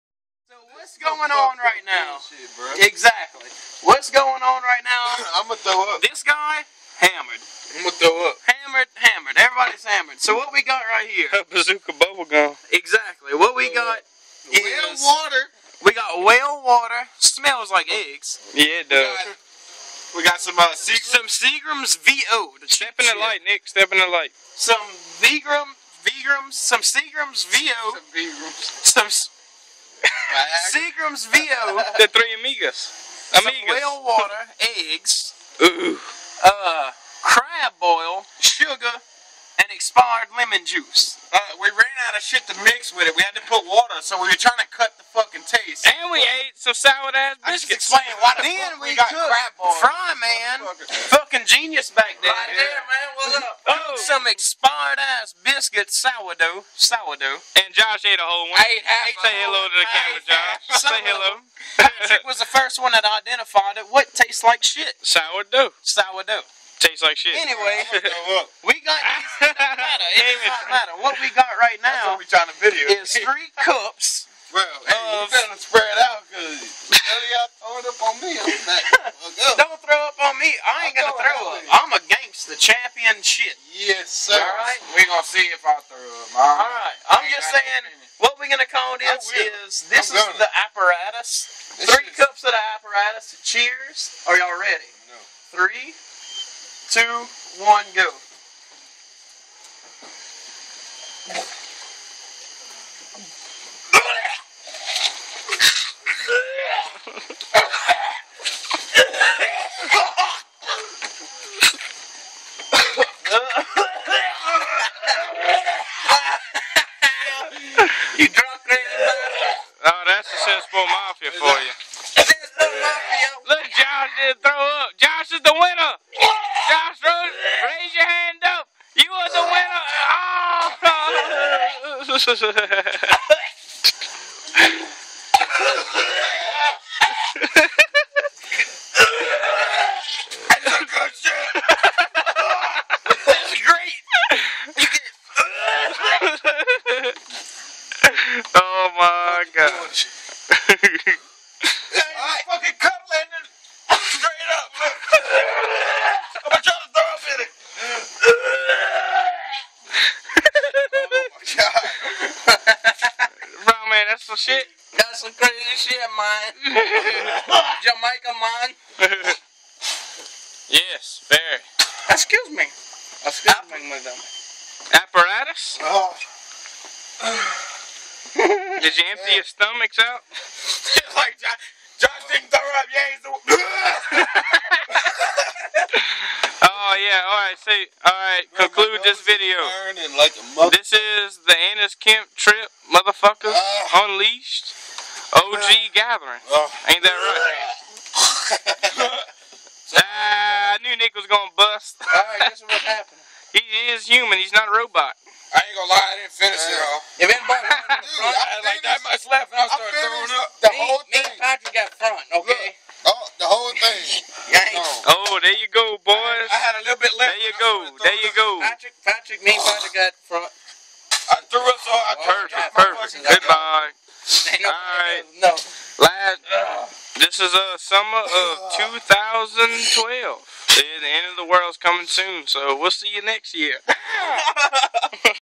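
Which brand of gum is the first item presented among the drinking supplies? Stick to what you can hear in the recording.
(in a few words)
Bazooka.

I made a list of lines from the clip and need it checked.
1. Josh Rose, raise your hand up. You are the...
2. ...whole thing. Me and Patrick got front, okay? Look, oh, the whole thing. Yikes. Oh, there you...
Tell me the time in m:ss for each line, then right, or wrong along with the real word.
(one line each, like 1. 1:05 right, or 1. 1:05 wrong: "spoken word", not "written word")
1. 2:06 right
2. 3:30 right.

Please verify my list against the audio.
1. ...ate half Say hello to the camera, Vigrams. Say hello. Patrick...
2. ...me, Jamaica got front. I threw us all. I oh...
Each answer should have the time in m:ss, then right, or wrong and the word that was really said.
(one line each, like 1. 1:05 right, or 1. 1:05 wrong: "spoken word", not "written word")
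1. 0:58 wrong: "Josh", not "Vigrams"
2. 3:39 wrong: "Patrick", not "Jamaica".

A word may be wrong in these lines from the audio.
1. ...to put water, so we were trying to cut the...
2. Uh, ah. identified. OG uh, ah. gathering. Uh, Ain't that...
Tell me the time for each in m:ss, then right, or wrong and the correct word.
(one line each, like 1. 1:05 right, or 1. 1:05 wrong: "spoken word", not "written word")
1. 0:43 right
2. 3:13 wrong: "unleashed", not "identified".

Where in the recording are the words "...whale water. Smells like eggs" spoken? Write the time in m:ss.
0:16.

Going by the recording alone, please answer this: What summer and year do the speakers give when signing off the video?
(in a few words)
Summer of 2012.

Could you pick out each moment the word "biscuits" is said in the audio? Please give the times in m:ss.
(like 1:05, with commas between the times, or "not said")
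0:47, 0:55.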